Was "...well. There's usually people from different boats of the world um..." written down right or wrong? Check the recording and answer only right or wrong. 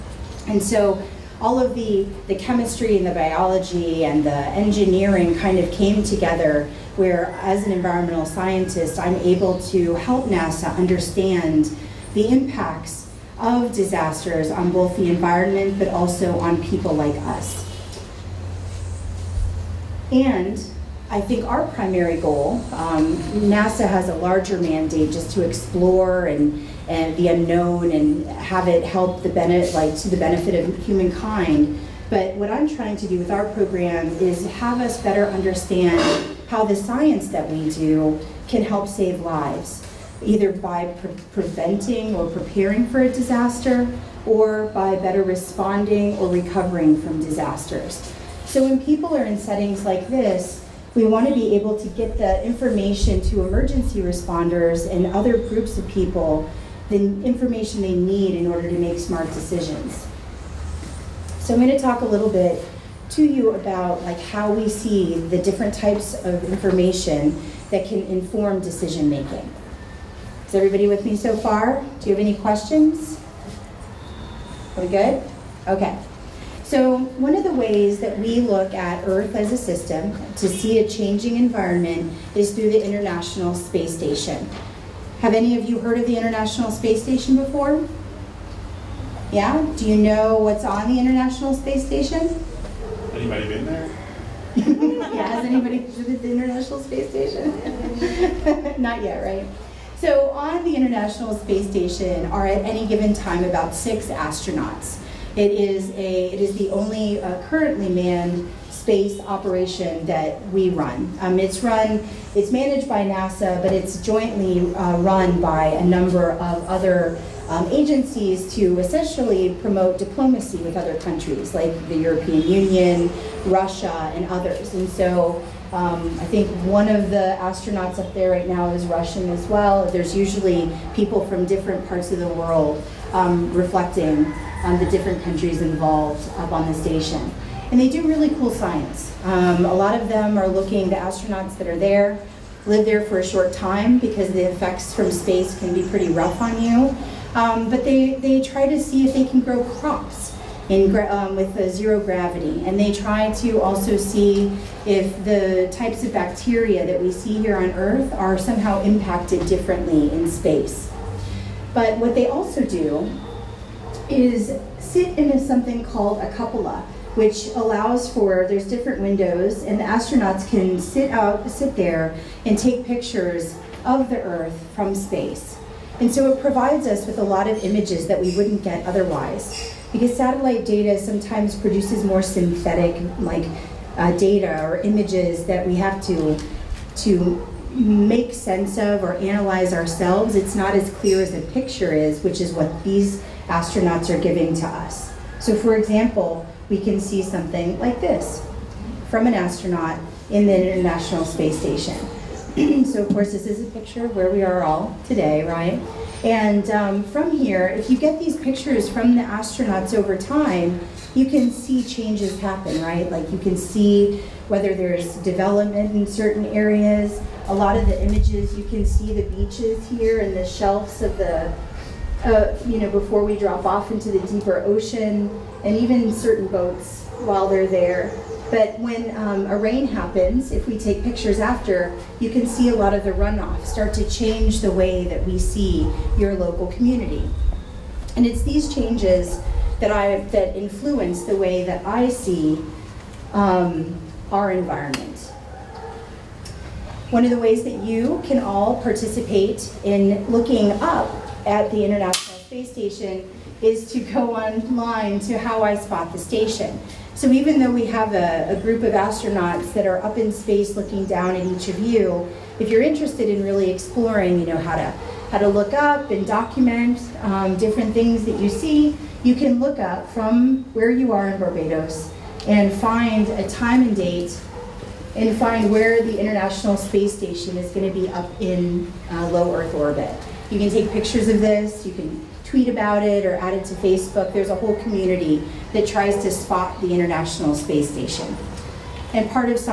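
wrong.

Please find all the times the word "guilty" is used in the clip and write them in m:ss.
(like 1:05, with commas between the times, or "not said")
not said.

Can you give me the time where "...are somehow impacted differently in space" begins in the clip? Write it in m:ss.
2:38.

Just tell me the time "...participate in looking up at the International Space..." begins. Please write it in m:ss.
4:08.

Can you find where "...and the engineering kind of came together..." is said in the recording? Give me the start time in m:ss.
0:04.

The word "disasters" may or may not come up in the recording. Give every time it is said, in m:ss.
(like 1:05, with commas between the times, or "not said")
0:13, 0:43, 0:47.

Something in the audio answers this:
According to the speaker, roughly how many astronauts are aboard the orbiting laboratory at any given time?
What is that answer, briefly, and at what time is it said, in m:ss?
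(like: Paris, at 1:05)
6, at 1:43.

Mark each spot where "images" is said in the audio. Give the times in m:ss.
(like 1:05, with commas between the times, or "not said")
2:57, 3:04, 3:38.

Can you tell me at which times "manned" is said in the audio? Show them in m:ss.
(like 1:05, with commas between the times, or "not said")
1:47.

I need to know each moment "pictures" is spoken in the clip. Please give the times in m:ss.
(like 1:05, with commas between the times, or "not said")
2:52, 3:11, 3:23, 3:28, 3:51, 4:40.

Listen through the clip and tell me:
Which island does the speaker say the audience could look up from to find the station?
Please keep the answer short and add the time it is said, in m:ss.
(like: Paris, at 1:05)
Barbados, at 4:31.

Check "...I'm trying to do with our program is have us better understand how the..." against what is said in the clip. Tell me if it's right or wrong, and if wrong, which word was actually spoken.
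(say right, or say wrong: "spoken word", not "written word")
right.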